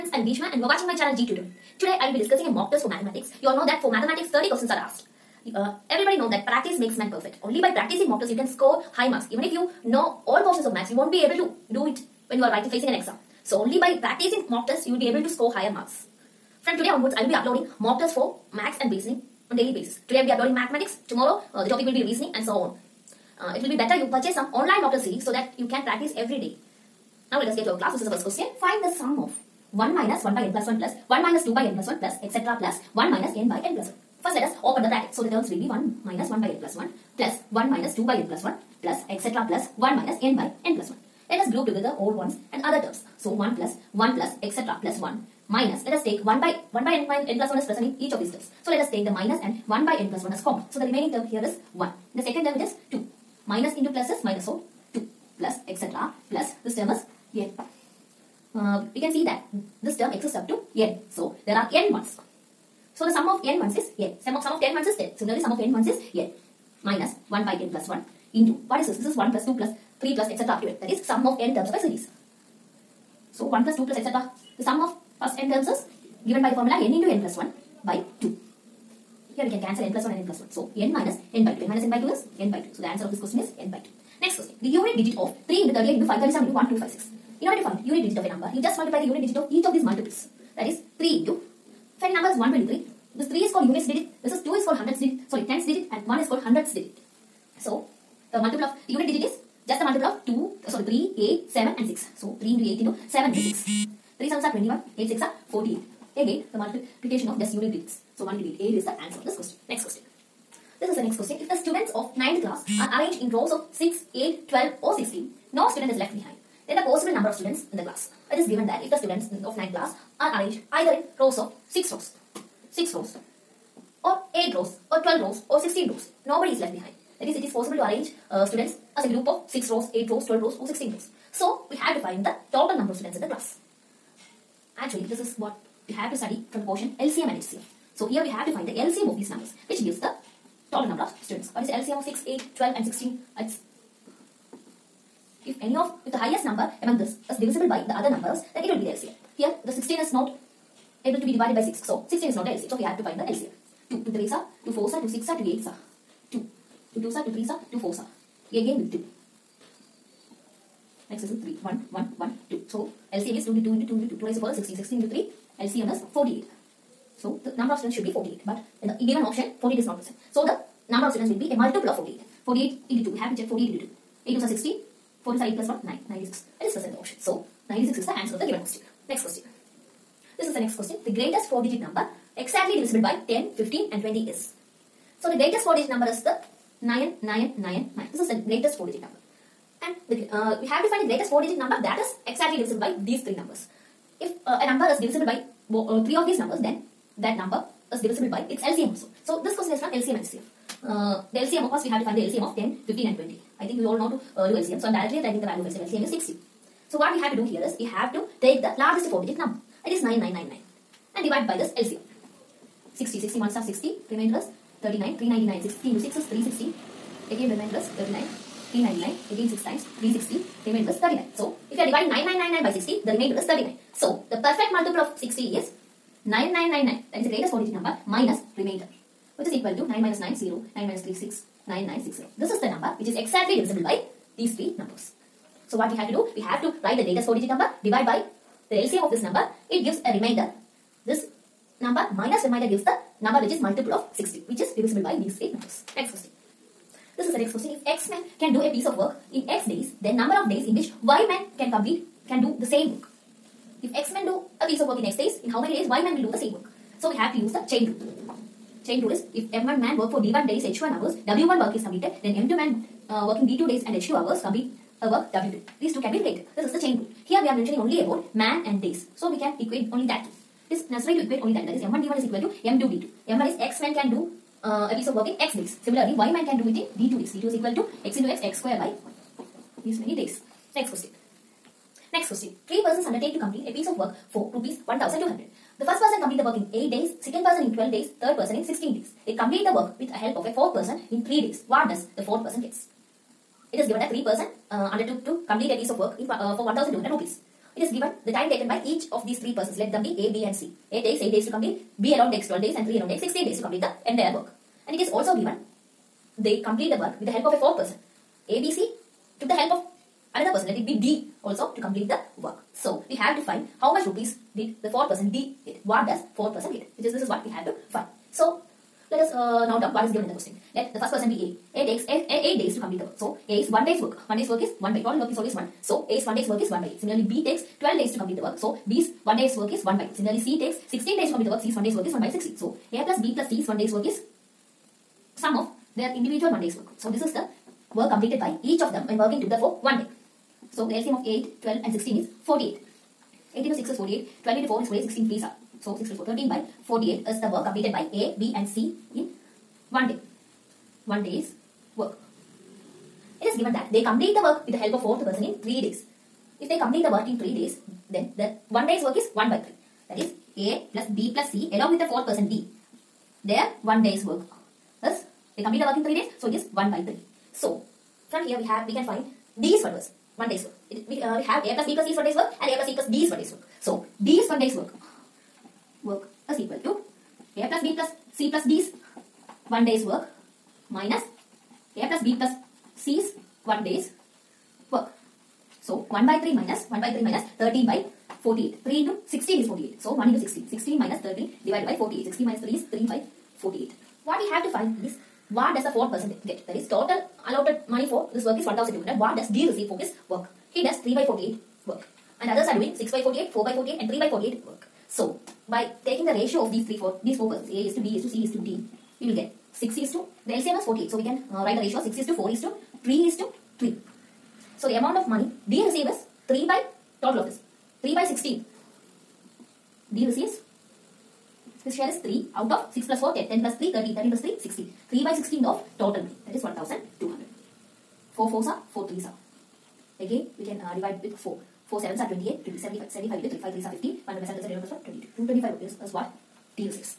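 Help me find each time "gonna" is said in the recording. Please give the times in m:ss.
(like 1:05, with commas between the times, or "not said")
not said.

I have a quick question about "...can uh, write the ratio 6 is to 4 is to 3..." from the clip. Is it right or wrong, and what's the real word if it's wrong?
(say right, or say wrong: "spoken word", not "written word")
right.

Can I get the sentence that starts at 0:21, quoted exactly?
Tomorrow uh, the topic will be reasoning and so on.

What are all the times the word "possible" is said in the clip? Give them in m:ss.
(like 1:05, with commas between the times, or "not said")
1:56, 2:07.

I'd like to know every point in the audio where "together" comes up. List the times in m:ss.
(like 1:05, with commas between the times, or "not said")
0:41, 5:39.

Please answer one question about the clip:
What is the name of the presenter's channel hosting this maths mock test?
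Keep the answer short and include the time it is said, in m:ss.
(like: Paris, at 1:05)
G Tutor, at 0:01.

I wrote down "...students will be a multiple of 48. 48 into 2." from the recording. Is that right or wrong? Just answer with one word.
right.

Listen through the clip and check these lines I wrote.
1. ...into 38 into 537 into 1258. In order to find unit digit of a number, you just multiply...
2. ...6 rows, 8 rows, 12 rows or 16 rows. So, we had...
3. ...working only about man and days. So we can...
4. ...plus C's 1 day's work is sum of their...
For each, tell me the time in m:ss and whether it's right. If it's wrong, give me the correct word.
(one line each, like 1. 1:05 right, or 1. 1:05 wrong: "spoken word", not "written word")
1. 1:25 wrong: "1256", not "1258"
2. 2:09 right
3. 4:27 wrong: "mentioning", not "working"
4. 5:33 right.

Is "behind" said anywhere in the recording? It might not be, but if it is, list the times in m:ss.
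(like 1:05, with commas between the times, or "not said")
1:56, 2:06.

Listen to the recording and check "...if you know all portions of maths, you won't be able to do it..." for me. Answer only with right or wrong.
right.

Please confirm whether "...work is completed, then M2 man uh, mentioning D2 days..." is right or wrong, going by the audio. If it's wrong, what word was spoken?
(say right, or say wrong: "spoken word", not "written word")
wrong: "working", not "mentioning".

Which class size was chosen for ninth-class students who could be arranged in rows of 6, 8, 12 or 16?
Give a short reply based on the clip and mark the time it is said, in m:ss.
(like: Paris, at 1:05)
96, at 2:57.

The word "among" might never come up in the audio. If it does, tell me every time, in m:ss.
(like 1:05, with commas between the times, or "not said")
2:26.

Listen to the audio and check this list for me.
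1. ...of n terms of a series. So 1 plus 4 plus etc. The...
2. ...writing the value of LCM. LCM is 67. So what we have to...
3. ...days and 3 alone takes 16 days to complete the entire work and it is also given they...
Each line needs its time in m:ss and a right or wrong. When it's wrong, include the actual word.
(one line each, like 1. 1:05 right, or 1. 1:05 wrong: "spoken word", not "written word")
1. 1:11 wrong: "2", not "4"
2. 3:25 wrong: "60", not "67"
3. 5:02 right.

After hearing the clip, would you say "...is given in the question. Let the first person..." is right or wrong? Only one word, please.
right.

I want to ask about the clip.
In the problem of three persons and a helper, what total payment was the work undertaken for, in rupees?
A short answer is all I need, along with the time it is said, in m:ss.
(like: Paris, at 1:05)
1200, at 4:44.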